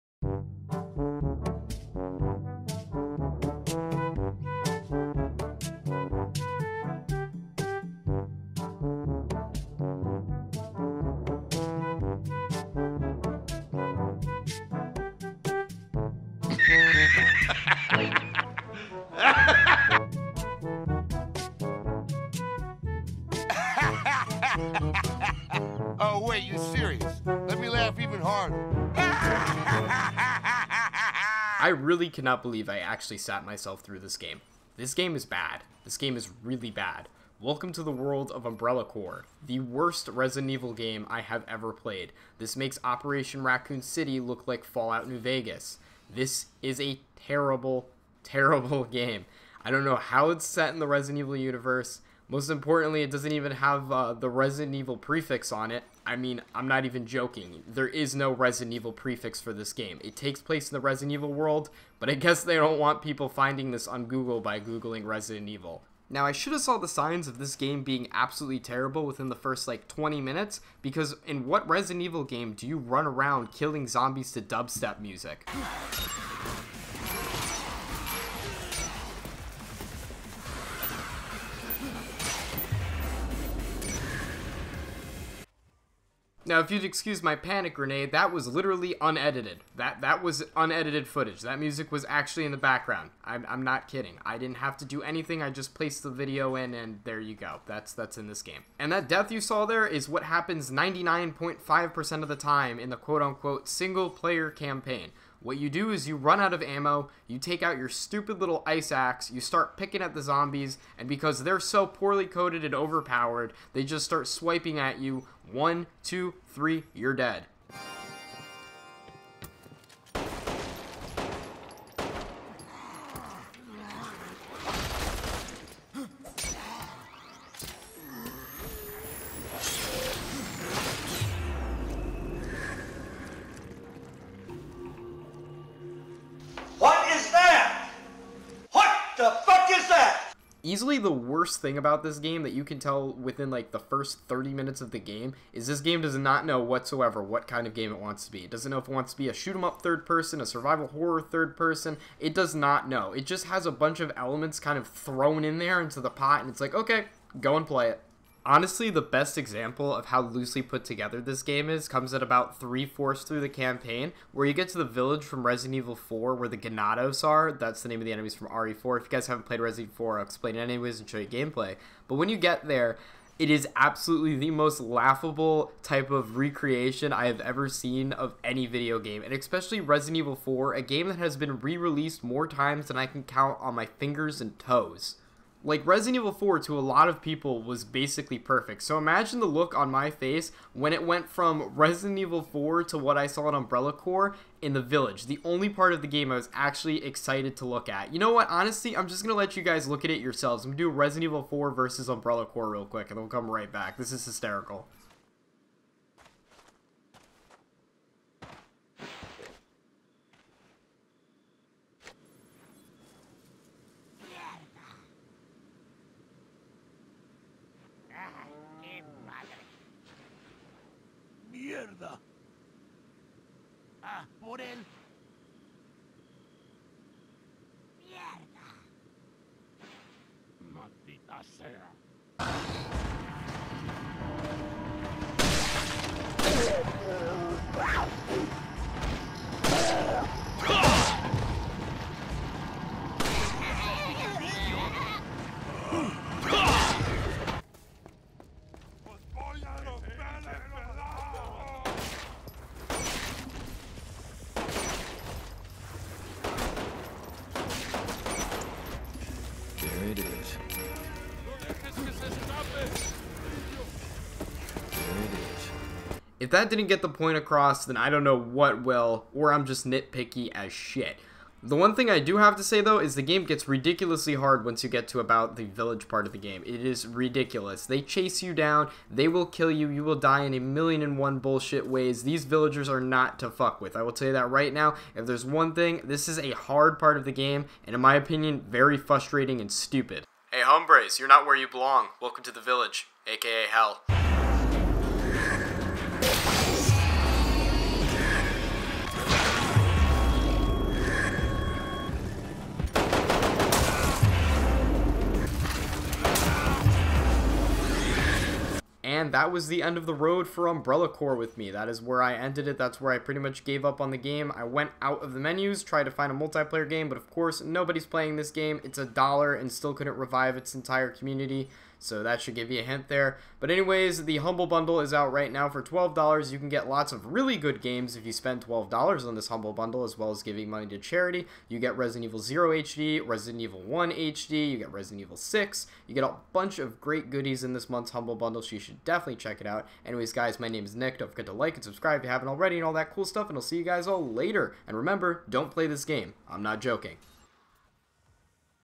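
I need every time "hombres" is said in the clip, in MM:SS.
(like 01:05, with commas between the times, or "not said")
04:50.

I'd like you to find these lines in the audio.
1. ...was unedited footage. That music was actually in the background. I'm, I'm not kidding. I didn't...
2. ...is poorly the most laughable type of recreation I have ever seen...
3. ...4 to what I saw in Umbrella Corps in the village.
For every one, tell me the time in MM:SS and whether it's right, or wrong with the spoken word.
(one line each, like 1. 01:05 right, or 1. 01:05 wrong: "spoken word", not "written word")
1. 01:30 right
2. 02:53 wrong: "absolutely", not "poorly"
3. 03:12 right.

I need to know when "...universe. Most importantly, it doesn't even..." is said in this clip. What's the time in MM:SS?
00:51.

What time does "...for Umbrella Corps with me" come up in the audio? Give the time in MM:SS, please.
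05:10.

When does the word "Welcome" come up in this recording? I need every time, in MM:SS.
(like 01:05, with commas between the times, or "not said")
00:37, 04:52.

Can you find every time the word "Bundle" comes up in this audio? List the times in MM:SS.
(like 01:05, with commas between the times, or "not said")
05:24, 05:29, 05:38.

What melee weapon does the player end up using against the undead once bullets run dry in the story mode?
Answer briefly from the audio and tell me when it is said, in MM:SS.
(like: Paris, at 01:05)
ice axe, at 01:48.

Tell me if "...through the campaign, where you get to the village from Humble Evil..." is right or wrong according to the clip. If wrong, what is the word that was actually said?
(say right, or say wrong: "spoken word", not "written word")
wrong: "Resident", not "Humble".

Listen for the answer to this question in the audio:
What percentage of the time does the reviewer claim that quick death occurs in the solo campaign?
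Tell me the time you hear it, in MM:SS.
01:40.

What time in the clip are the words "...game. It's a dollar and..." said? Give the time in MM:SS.
05:18.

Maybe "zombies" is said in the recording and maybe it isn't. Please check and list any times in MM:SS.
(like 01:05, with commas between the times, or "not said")
01:13, 01:50.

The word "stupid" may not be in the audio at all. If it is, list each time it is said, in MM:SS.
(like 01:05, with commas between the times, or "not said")
01:47, 04:49.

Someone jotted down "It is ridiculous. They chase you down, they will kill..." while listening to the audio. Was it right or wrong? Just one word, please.
right.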